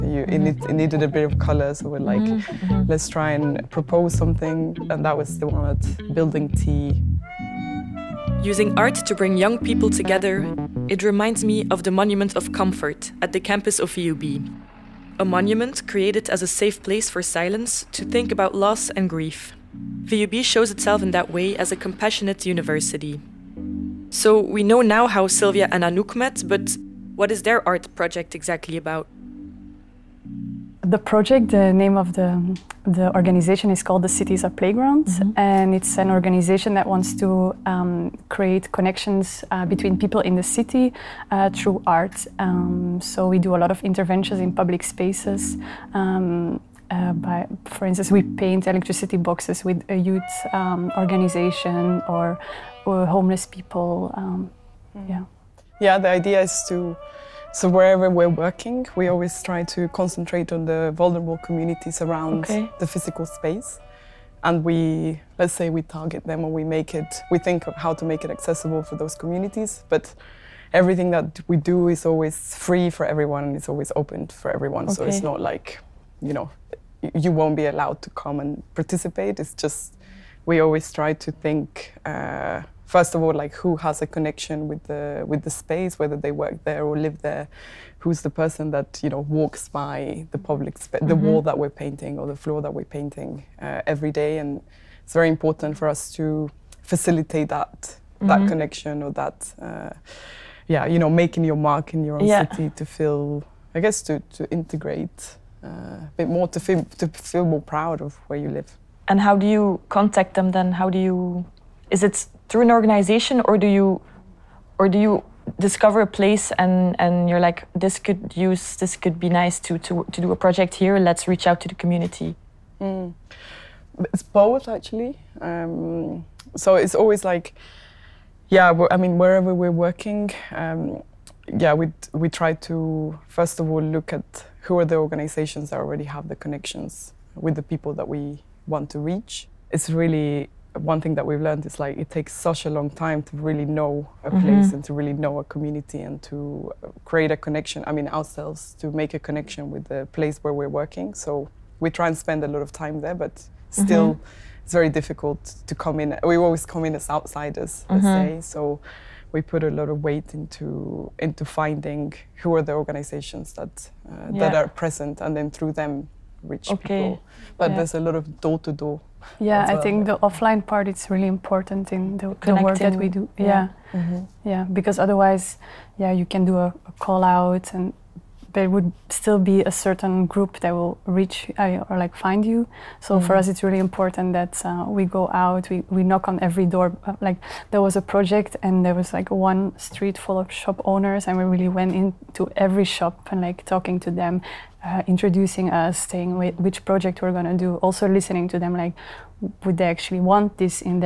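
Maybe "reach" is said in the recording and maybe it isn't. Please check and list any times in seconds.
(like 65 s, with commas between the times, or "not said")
121 s, 138 s, 166 s, 181 s.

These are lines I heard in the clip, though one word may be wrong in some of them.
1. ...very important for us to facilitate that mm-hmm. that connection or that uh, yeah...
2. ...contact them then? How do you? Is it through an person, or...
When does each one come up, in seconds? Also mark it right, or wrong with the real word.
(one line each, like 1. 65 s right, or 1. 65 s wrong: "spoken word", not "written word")
1. 95 s right
2. 109 s wrong: "organization", not "person".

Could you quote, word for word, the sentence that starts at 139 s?
It's really one thing that we've learned is like it takes such a long time to really know a mm-hmm.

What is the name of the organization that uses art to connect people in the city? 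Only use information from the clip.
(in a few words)
The Cities Are Playgrounds.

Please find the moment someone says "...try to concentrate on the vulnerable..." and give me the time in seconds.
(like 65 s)
59 s.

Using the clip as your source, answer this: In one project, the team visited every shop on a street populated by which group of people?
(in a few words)
shop owners.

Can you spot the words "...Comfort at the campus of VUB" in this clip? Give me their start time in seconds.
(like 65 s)
12 s.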